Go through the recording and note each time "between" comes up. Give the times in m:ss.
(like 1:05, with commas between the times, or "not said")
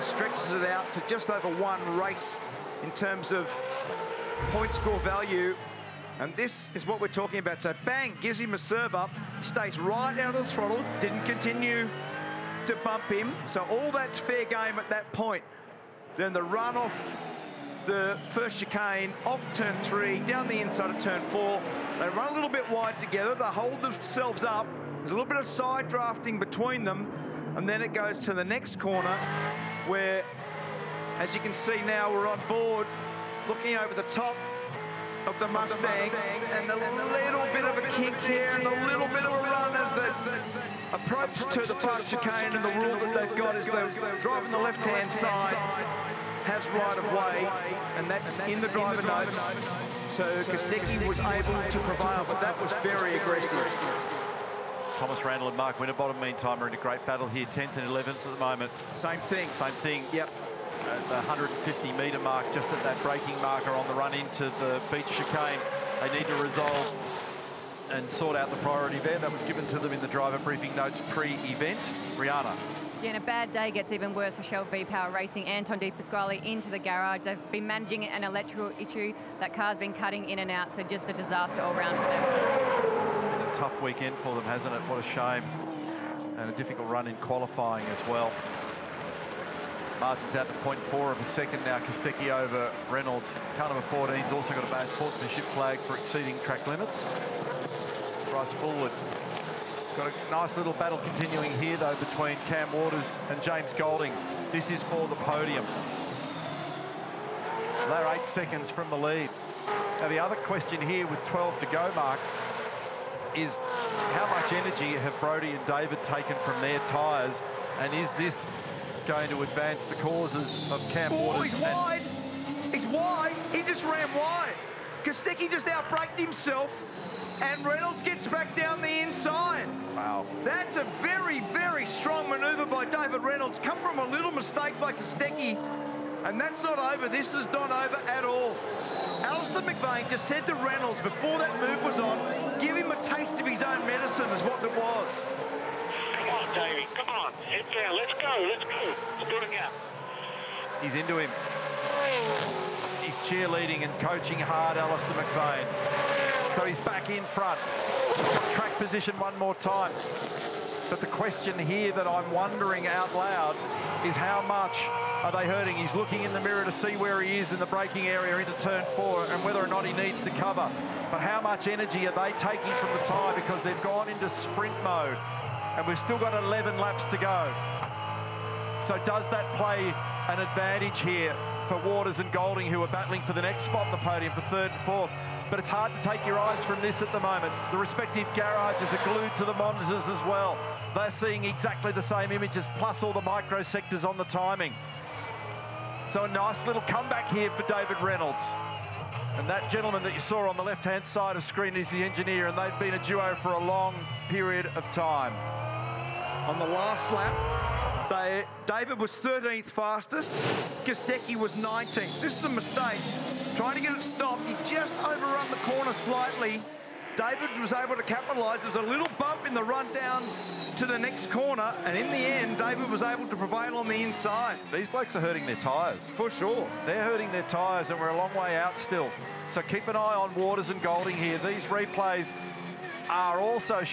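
0:26, 1:41.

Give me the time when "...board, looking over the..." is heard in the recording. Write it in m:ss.
0:32.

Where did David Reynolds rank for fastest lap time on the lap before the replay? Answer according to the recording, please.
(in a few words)
13th.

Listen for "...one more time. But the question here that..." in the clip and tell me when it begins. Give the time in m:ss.
2:39.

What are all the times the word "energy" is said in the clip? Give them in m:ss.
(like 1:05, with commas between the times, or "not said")
1:54, 2:51.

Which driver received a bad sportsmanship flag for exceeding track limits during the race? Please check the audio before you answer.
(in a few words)
Bryce Fullwood.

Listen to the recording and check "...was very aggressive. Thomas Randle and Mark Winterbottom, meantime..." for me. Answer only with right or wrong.
right.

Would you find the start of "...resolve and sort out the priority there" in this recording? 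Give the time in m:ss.
1:06.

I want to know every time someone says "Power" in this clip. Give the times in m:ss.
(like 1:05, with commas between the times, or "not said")
1:14.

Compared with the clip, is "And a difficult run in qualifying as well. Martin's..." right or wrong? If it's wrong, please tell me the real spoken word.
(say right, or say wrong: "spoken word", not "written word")
right.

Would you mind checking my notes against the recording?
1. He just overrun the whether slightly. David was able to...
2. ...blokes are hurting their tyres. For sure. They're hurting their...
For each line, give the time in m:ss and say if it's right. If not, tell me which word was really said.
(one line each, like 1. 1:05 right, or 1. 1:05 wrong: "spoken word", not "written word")
1. 3:34 wrong: "corner", not "whether"
2. 3:44 right.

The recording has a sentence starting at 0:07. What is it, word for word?
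So bang, gives him a serve up, stays right out of the throttle, didn't continue to bump him.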